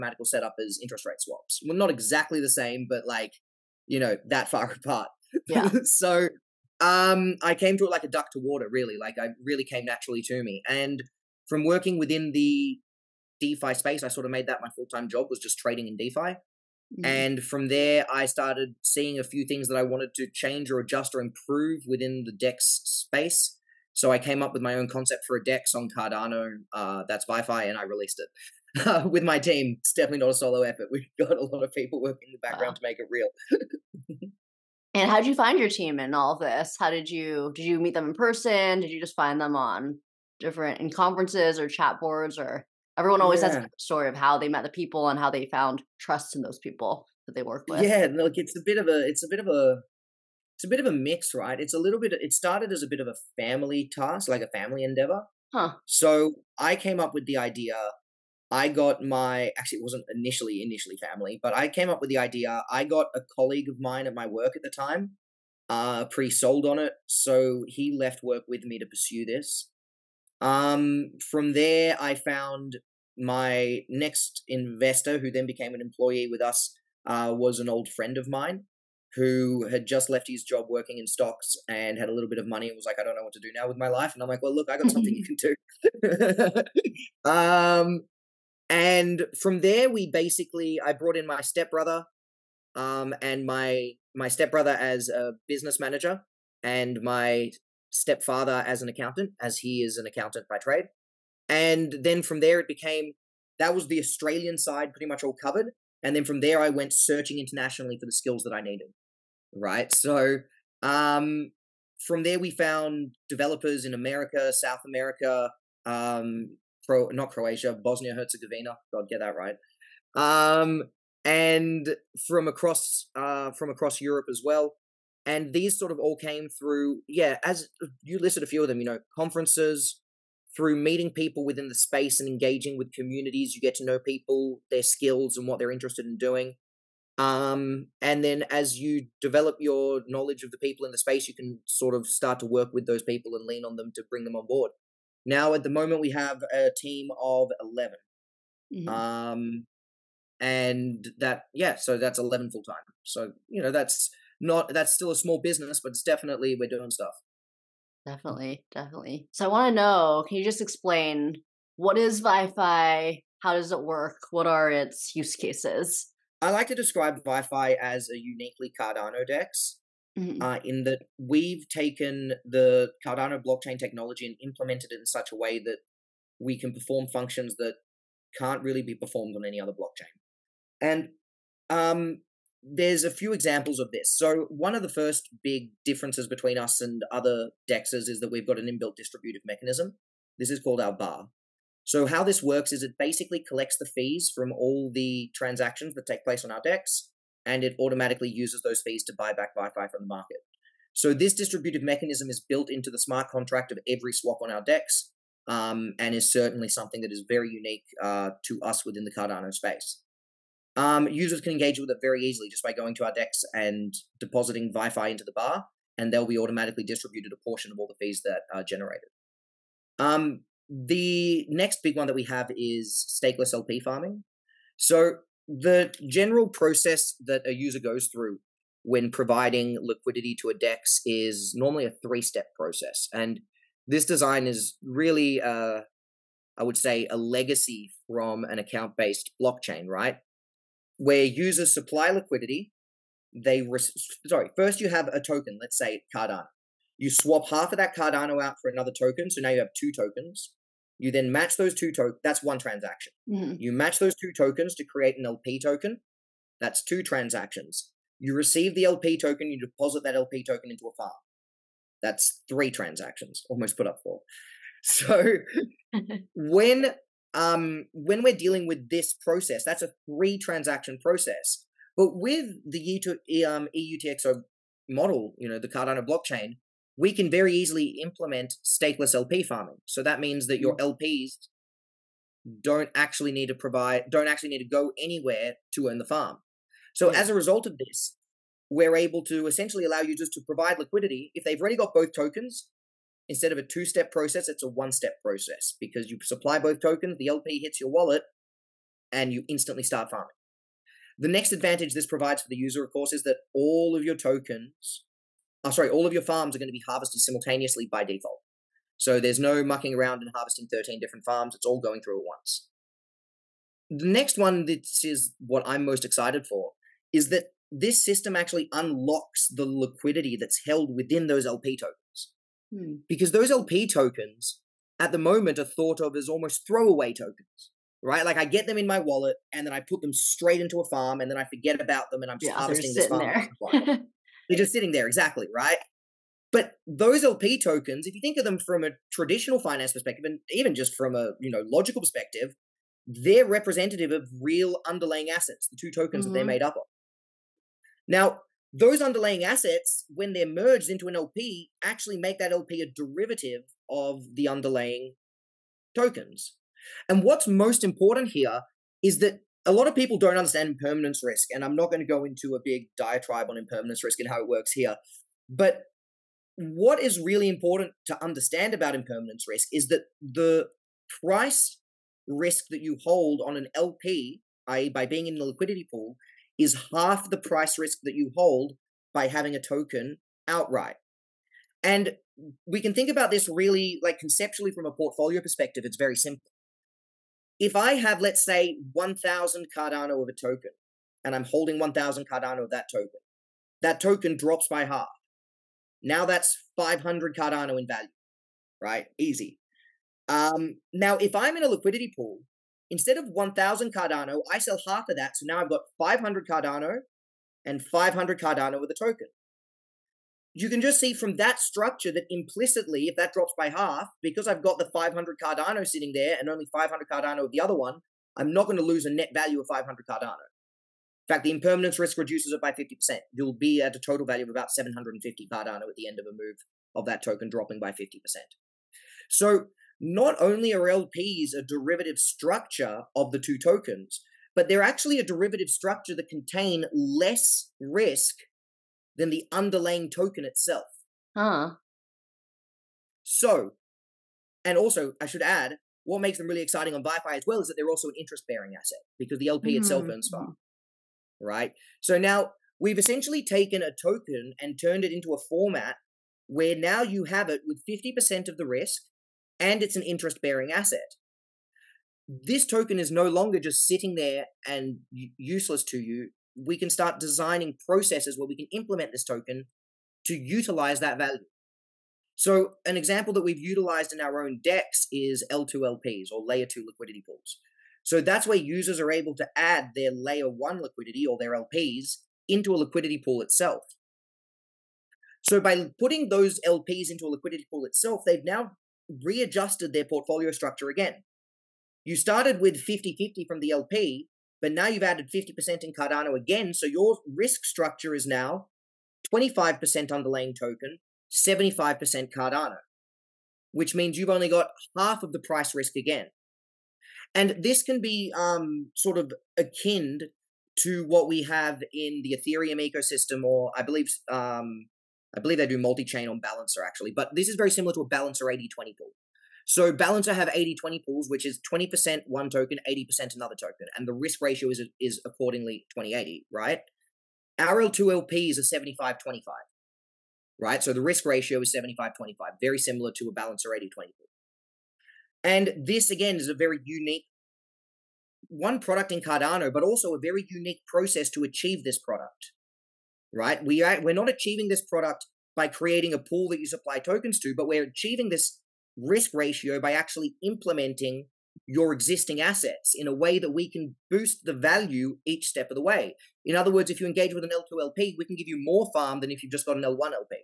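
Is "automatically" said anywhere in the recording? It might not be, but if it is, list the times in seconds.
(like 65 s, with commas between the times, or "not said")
197 s, 216 s.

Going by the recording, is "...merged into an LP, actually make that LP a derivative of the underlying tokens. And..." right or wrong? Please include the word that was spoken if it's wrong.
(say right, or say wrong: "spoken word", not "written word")
right.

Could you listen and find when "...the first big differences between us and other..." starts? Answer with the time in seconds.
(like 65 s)
184 s.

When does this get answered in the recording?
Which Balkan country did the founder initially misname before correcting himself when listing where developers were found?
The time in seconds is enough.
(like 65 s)
117 s.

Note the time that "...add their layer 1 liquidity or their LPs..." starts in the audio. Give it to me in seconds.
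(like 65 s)
479 s.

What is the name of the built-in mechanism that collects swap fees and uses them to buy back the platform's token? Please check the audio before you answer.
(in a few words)
The bar.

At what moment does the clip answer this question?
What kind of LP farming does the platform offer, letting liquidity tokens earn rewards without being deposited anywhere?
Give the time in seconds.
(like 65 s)
223 s.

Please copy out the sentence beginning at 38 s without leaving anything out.
Did you just find them on different in conferences or chat boards or?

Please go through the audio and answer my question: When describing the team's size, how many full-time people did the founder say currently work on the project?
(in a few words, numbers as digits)
11.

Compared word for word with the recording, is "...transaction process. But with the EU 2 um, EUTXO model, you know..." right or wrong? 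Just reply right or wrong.
right.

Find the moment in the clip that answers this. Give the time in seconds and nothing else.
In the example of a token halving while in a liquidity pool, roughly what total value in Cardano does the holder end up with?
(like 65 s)
424 s.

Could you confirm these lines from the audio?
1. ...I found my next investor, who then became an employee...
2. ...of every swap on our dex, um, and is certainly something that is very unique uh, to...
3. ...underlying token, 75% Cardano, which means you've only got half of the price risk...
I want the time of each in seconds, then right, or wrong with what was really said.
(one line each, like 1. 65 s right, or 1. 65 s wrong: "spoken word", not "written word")
1. 71 s right
2. 203 s right
3. 500 s right.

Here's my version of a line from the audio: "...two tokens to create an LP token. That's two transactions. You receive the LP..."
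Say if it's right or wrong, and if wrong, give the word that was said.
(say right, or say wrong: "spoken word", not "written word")
right.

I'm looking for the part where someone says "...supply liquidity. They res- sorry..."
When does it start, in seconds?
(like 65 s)
241 s.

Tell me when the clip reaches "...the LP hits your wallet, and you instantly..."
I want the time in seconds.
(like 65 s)
297 s.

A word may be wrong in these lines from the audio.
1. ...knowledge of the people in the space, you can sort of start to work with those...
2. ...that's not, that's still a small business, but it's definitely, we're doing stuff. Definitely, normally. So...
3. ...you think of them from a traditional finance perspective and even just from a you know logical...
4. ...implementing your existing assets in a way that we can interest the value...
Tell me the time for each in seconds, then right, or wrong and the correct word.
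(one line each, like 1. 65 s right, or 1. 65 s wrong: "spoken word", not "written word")
1. 140 s right
2. 153 s wrong: "definitely", not "normally"
3. 338 s right
4. 550 s wrong: "boost", not "interest".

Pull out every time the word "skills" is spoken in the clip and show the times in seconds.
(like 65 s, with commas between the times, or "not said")
108 s, 134 s.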